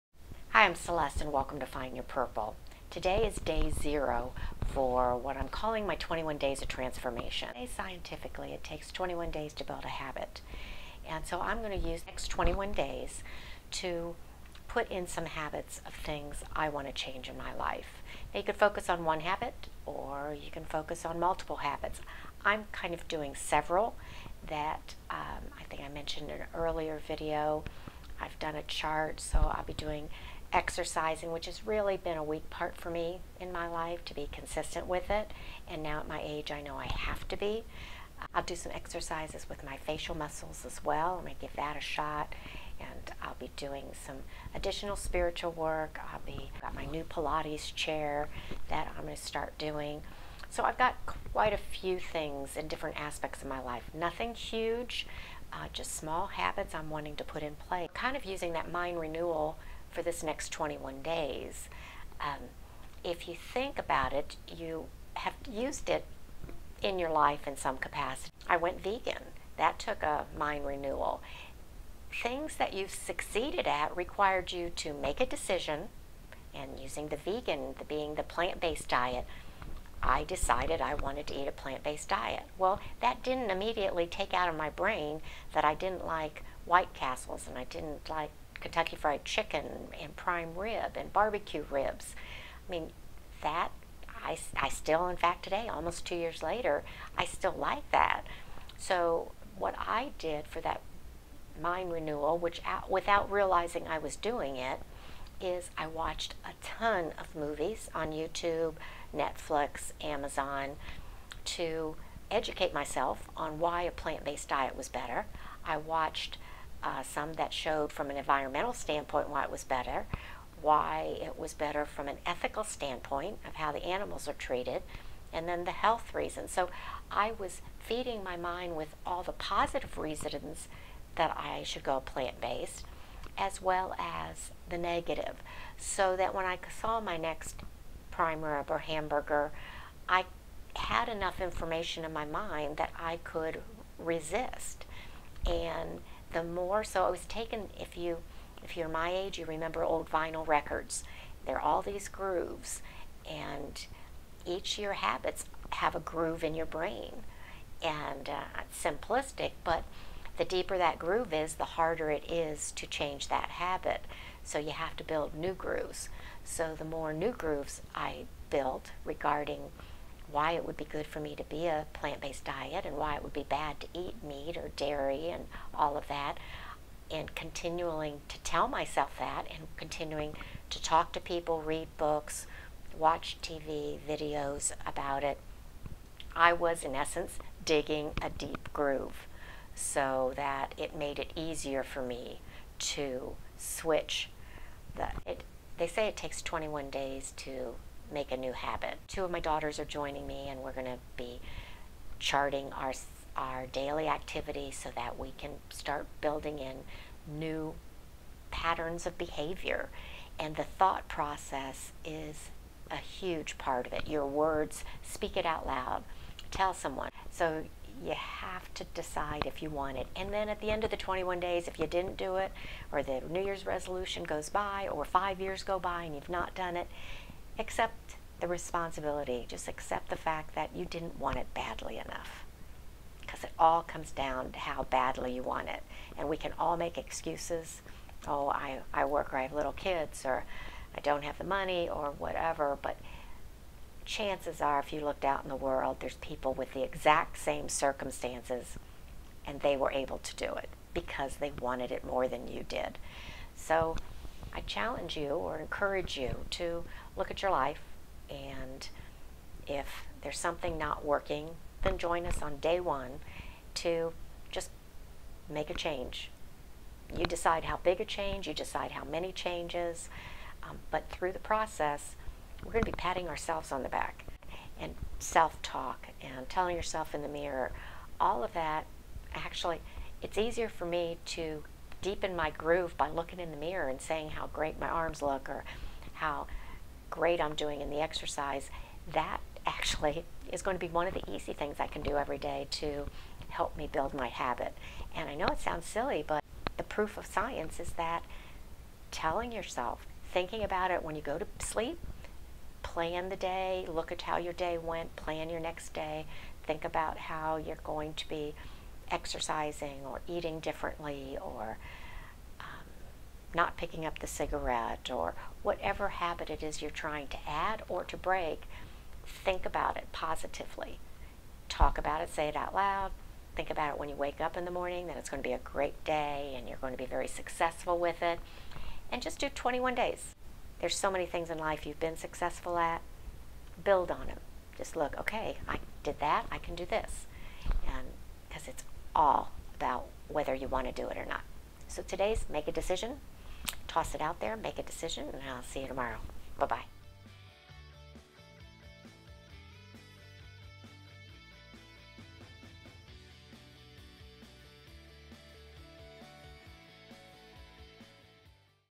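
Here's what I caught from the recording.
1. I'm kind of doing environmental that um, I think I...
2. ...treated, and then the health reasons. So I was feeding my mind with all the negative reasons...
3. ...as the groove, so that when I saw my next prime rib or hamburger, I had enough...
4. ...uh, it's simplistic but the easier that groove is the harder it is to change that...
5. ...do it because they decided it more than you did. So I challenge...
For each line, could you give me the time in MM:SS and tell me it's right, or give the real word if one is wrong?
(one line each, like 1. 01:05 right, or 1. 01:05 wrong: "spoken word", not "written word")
1. 00:22 wrong: "several", not "environmental"
2. 02:04 wrong: "positive", not "negative"
3. 02:13 wrong: "negative", not "groove"
4. 02:38 wrong: "deeper", not "easier"
5. 04:10 wrong: "wanted", not "decided".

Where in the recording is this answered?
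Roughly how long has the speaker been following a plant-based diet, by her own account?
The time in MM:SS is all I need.
01:35.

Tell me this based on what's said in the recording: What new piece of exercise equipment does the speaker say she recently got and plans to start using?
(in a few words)
Pilates chair.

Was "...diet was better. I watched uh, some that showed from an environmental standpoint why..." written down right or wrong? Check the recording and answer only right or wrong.
right.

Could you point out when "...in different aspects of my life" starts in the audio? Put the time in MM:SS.
00:52.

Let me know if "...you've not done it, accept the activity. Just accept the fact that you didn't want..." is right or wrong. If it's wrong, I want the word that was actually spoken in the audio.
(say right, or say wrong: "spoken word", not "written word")
wrong: "responsibility", not "activity".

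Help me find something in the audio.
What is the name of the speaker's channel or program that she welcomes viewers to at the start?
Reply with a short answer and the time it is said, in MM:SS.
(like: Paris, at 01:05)
Find Your Purple, at 00:01.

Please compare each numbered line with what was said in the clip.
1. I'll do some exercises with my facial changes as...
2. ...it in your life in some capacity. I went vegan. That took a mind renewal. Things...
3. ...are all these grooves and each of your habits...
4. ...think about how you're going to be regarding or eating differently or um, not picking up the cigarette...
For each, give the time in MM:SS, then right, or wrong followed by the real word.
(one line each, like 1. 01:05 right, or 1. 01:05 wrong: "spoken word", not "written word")
1. 00:38 wrong: "muscles", not "changes"
2. 01:05 right
3. 02:31 right
4. 05:06 wrong: "exercising", not "regarding".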